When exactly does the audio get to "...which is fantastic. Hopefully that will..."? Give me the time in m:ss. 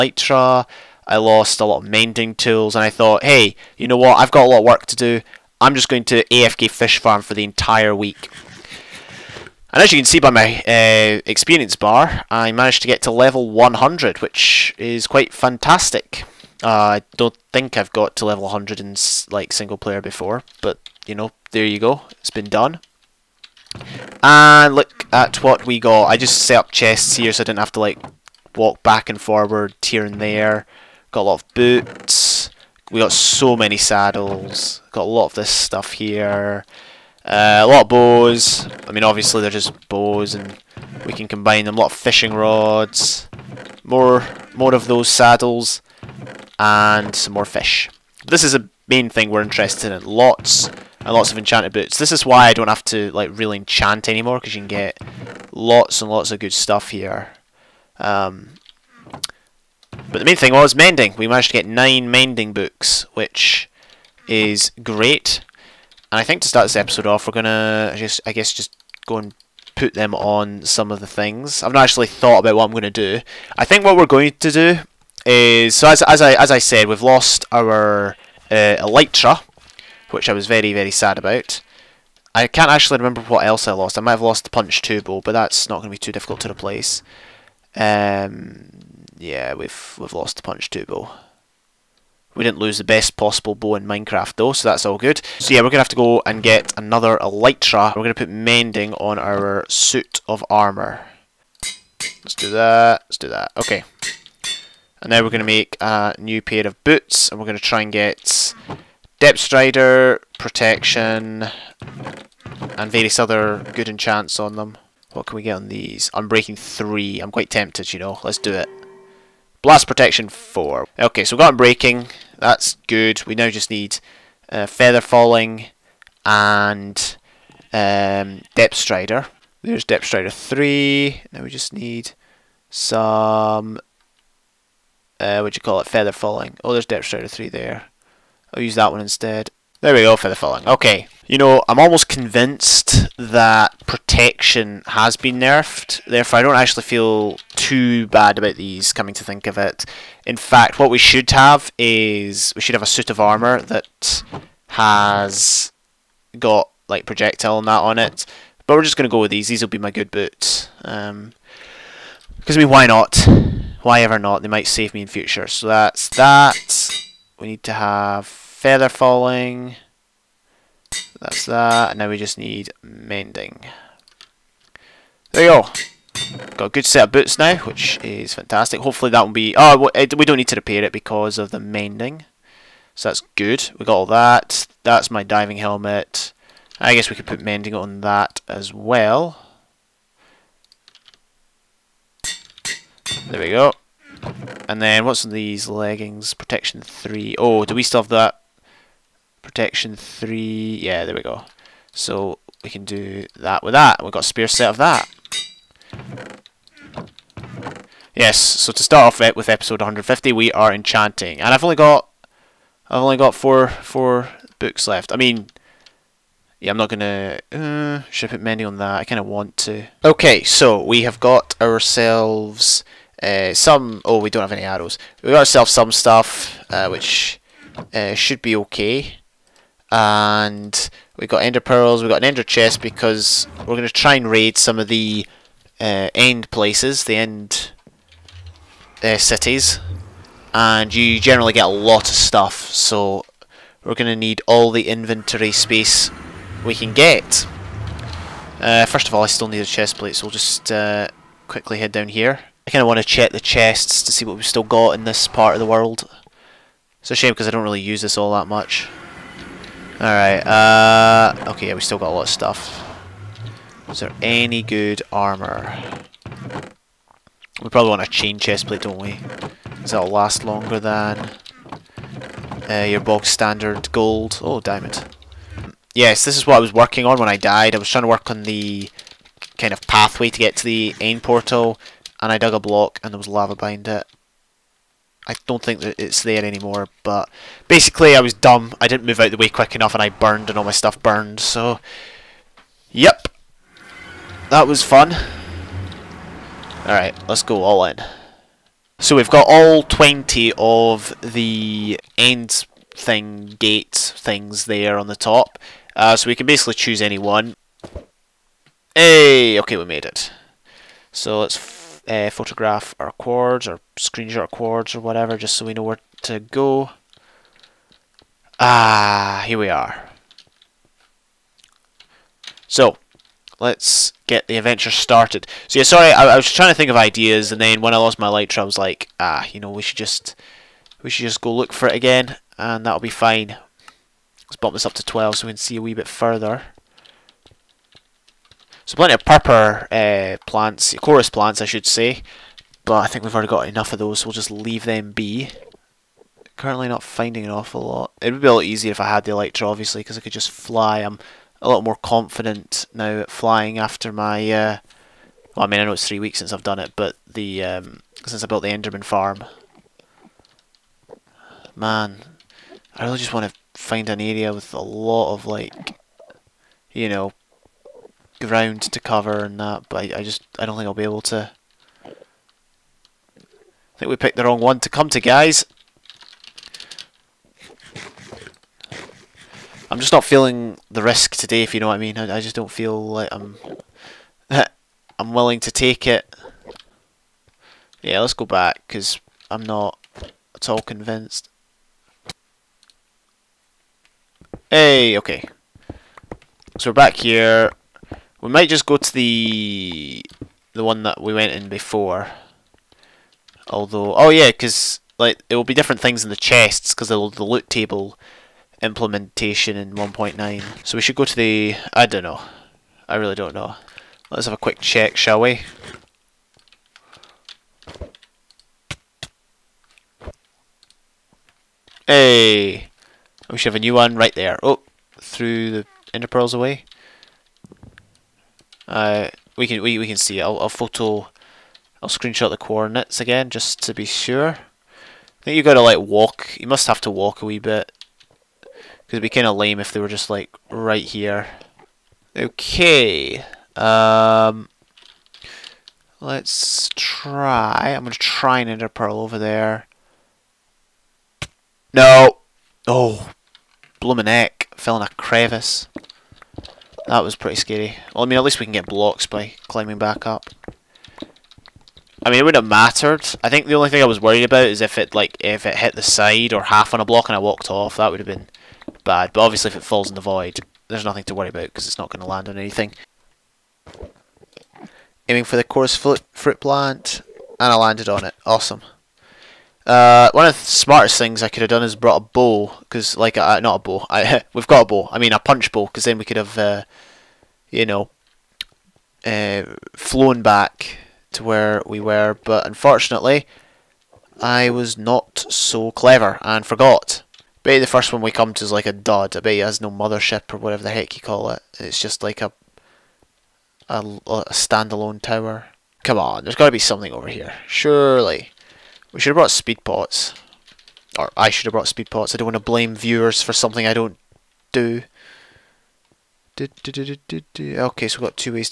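2:57.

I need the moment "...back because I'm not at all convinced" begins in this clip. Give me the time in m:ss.
6:28.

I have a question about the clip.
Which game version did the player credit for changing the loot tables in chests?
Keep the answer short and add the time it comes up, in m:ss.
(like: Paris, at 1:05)
1.9, at 6:49.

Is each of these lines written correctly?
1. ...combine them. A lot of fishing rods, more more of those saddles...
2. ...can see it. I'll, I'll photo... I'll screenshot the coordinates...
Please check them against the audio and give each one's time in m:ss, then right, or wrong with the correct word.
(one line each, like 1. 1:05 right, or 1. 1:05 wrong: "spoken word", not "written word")
1. 0:41 right
2. 7:10 right.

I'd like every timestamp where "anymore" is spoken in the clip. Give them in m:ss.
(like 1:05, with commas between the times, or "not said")
0:54, 4:46.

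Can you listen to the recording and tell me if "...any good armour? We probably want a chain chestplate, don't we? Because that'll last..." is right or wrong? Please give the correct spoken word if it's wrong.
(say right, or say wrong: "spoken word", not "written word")
right.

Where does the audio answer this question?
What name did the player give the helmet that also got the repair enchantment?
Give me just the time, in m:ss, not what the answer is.
3:05.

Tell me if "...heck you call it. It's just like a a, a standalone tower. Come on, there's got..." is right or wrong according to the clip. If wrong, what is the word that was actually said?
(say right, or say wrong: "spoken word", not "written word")
right.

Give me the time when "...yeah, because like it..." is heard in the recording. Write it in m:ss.
6:44.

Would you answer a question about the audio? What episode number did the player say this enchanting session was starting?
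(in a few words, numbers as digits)
150.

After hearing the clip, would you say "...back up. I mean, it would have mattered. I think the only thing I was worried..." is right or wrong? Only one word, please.
right.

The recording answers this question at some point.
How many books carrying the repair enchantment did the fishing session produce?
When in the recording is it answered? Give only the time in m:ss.
1:01.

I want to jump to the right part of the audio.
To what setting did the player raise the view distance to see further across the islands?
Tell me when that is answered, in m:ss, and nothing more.
5:35.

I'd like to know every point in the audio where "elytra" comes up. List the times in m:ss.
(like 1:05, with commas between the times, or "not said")
1:18, 1:37, 5:28, 5:49.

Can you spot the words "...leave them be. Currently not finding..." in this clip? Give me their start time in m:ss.
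5:44.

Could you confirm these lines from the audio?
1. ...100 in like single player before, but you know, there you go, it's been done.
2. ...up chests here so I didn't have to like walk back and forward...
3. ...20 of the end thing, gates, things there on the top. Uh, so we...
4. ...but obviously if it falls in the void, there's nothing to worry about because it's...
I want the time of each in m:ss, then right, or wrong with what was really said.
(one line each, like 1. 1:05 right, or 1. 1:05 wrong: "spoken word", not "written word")
1. 0:18 right
2. 0:26 right
3. 4:59 right
4. 7:49 right.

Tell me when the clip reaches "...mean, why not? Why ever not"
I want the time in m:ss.
2:42.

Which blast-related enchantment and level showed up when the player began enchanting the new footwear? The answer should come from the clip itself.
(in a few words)
Blast Protection 4.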